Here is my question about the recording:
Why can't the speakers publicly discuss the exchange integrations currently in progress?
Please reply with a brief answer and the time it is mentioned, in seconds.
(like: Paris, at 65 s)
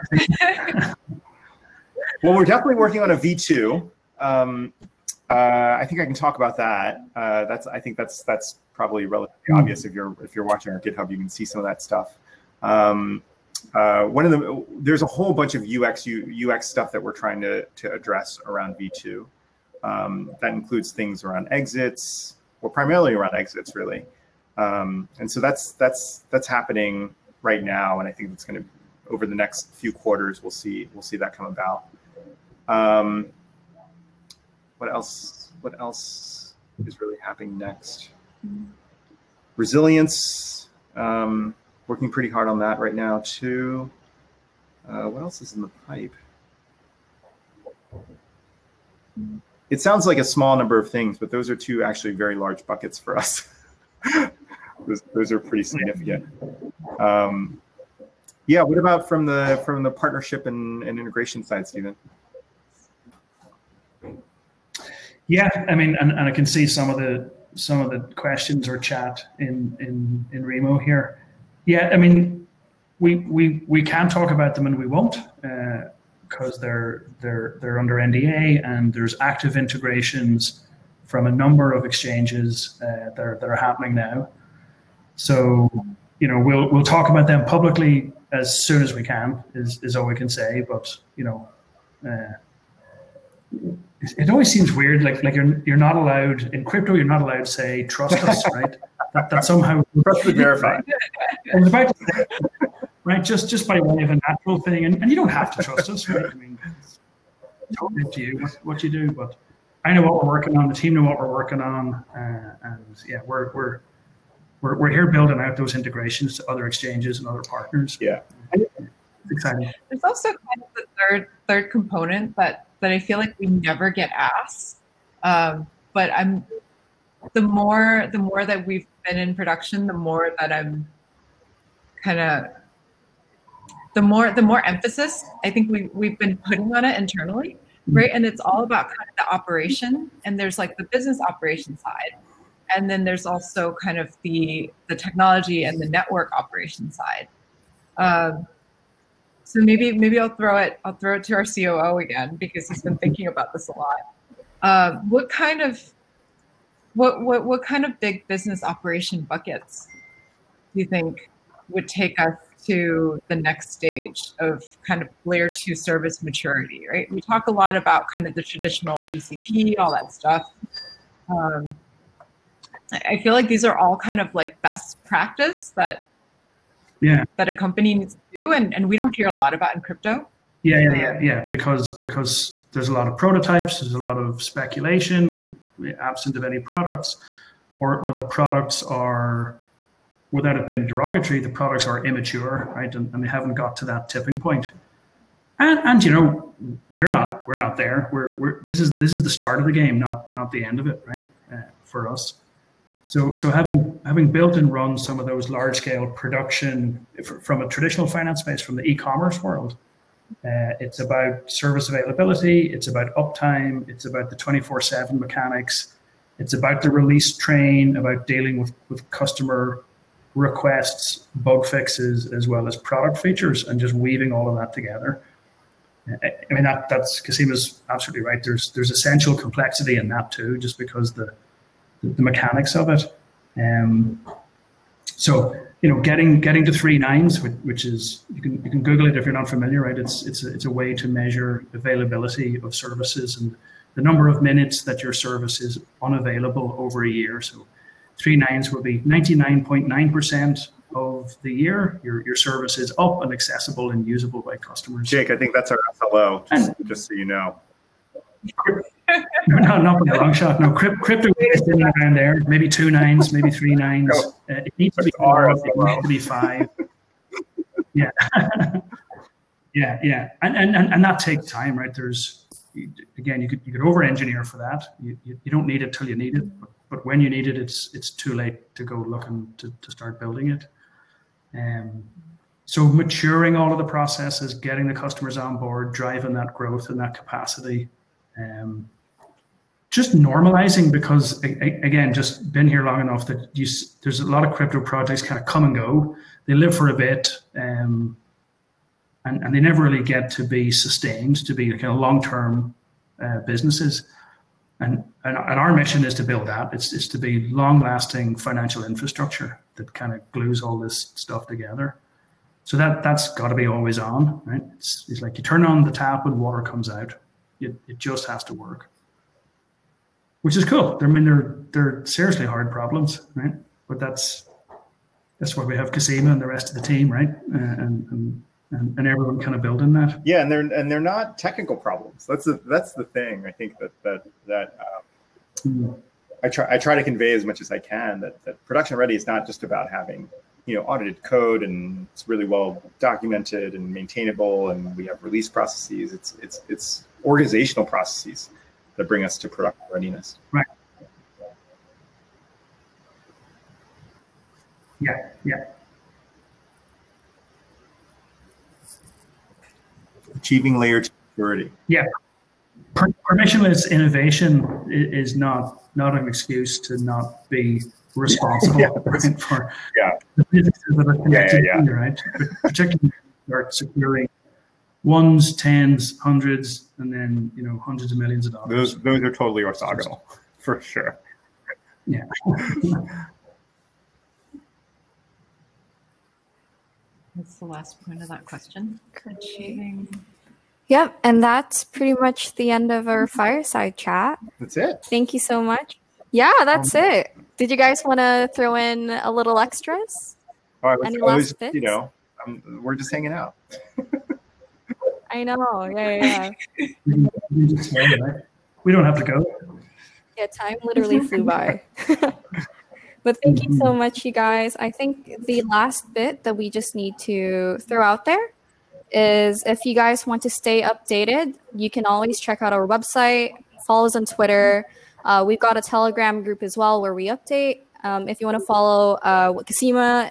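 They're under NDA, at 77 s.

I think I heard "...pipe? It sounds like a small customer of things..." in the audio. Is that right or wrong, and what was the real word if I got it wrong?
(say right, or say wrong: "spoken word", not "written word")
wrong: "number", not "customer".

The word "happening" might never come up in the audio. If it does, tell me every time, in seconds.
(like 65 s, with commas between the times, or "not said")
26 s, 37 s, 83 s.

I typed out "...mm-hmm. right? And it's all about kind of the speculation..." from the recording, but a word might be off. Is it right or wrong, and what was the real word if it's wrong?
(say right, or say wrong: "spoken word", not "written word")
wrong: "operation", not "speculation".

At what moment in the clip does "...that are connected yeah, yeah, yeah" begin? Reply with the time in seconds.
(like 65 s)
370 s.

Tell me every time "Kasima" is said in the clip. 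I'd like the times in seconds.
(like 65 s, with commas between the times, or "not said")
227 s, 325 s, 429 s.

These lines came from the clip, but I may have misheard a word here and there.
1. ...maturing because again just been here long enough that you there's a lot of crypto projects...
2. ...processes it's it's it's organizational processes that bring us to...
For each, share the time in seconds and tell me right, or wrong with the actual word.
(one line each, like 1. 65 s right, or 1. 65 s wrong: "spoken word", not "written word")
1. 290 s wrong: "normalizing", not "maturing"
2. 345 s right.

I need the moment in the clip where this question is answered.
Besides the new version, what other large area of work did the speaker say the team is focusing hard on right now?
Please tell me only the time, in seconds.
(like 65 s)
39 s.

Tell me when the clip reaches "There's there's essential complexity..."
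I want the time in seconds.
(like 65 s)
228 s.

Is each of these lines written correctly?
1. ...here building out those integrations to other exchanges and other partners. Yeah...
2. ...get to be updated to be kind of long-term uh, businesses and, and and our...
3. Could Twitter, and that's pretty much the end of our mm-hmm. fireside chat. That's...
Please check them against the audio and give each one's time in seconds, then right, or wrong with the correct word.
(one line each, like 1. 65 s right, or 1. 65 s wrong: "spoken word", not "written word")
1. 114 s right
2. 300 s wrong: "sustained", not "updated"
3. 389 s wrong: "Yep", not "Twitter".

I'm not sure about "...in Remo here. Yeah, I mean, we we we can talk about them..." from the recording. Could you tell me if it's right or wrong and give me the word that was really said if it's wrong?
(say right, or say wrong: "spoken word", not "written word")
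right.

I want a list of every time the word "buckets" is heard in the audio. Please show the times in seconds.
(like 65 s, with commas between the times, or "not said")
52 s, 159 s.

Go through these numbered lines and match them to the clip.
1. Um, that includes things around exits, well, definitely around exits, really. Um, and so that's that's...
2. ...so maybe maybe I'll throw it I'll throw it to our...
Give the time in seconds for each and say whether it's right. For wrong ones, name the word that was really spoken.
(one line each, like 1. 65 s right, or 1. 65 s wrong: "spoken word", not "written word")
1. 19 s wrong: "primarily", not "definitely"
2. 149 s right.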